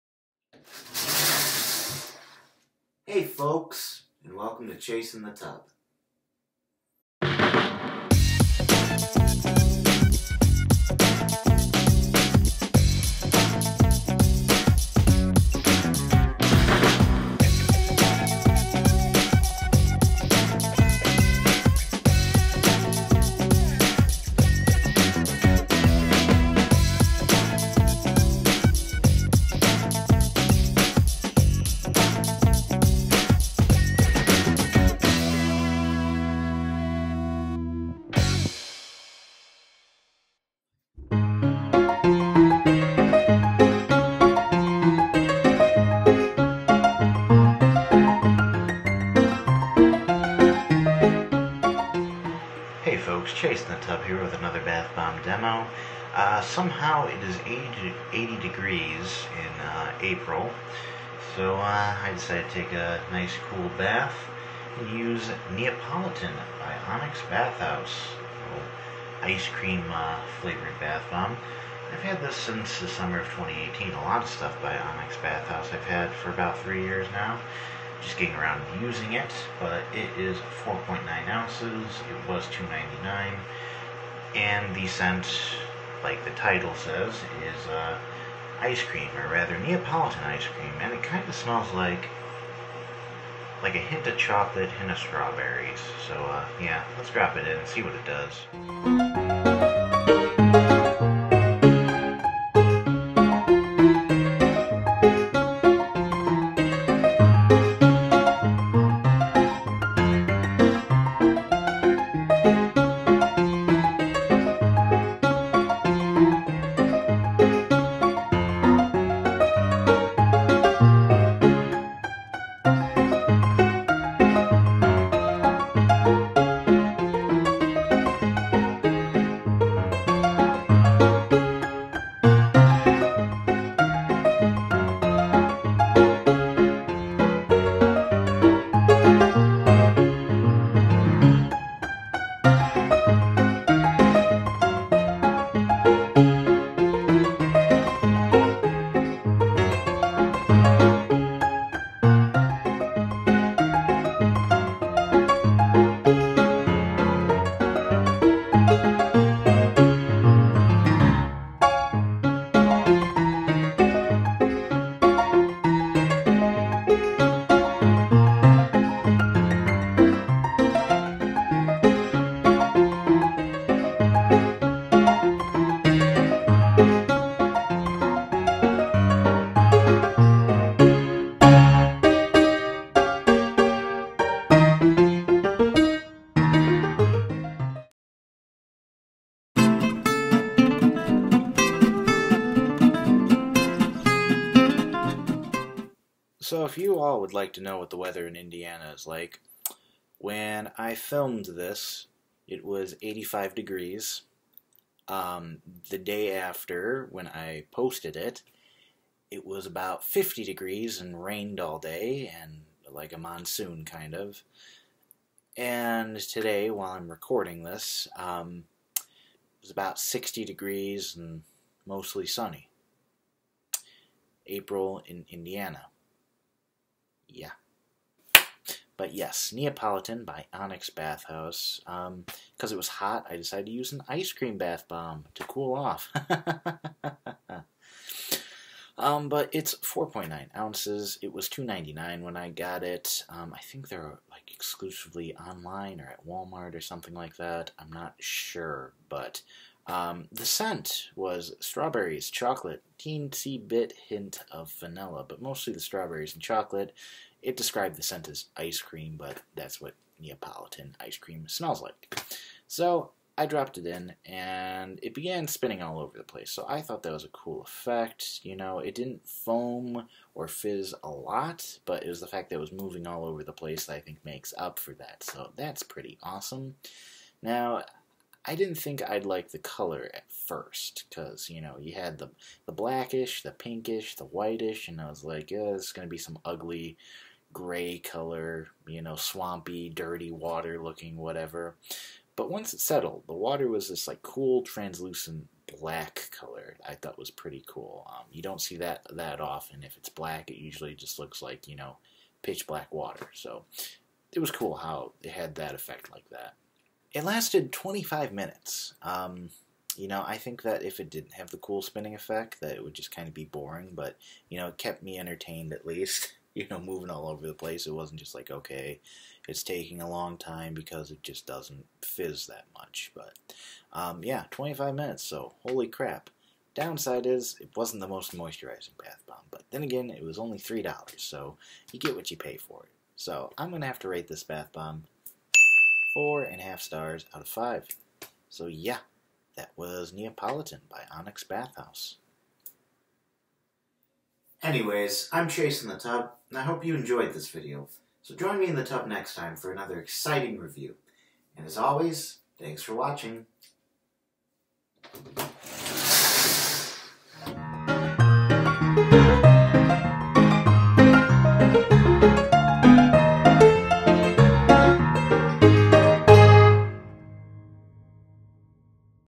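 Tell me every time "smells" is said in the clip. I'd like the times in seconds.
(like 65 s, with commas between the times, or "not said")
91 s, 261 s.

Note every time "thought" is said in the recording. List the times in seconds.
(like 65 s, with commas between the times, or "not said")
266 s, 296 s.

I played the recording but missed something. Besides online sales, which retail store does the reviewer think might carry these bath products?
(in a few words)
Walmart.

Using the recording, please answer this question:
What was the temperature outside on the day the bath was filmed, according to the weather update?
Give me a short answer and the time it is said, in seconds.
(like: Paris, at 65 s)
85 degrees, at 203 s.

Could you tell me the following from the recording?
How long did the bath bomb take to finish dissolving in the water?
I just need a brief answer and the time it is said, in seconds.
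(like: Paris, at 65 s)
25 minutes, at 307 s.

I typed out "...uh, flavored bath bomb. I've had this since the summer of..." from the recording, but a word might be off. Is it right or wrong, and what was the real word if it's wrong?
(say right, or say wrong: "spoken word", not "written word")
right.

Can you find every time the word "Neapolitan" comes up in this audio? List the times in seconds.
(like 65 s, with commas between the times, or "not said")
65 s, 89 s, 229 s, 260 s, 340 s.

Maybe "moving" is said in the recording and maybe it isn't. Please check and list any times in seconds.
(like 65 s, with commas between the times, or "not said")
272 s, 316 s.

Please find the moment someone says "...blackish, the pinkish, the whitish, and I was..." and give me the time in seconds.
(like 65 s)
282 s.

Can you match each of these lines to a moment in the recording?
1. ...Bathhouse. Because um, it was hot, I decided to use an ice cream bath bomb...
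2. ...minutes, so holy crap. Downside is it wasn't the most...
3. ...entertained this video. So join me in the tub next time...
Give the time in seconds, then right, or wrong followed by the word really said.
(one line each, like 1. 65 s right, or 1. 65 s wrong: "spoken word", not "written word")
1. 230 s right
2. 324 s right
3. 346 s wrong: "enjoyed", not "entertained".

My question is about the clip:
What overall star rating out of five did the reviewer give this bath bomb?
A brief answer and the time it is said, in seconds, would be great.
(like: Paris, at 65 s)
4.5 stars, at 336 s.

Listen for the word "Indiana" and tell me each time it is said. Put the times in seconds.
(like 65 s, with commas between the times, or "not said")
198 s, 225 s.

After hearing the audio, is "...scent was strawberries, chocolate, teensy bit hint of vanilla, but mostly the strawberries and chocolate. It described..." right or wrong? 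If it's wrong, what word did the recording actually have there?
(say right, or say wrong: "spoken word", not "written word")
right.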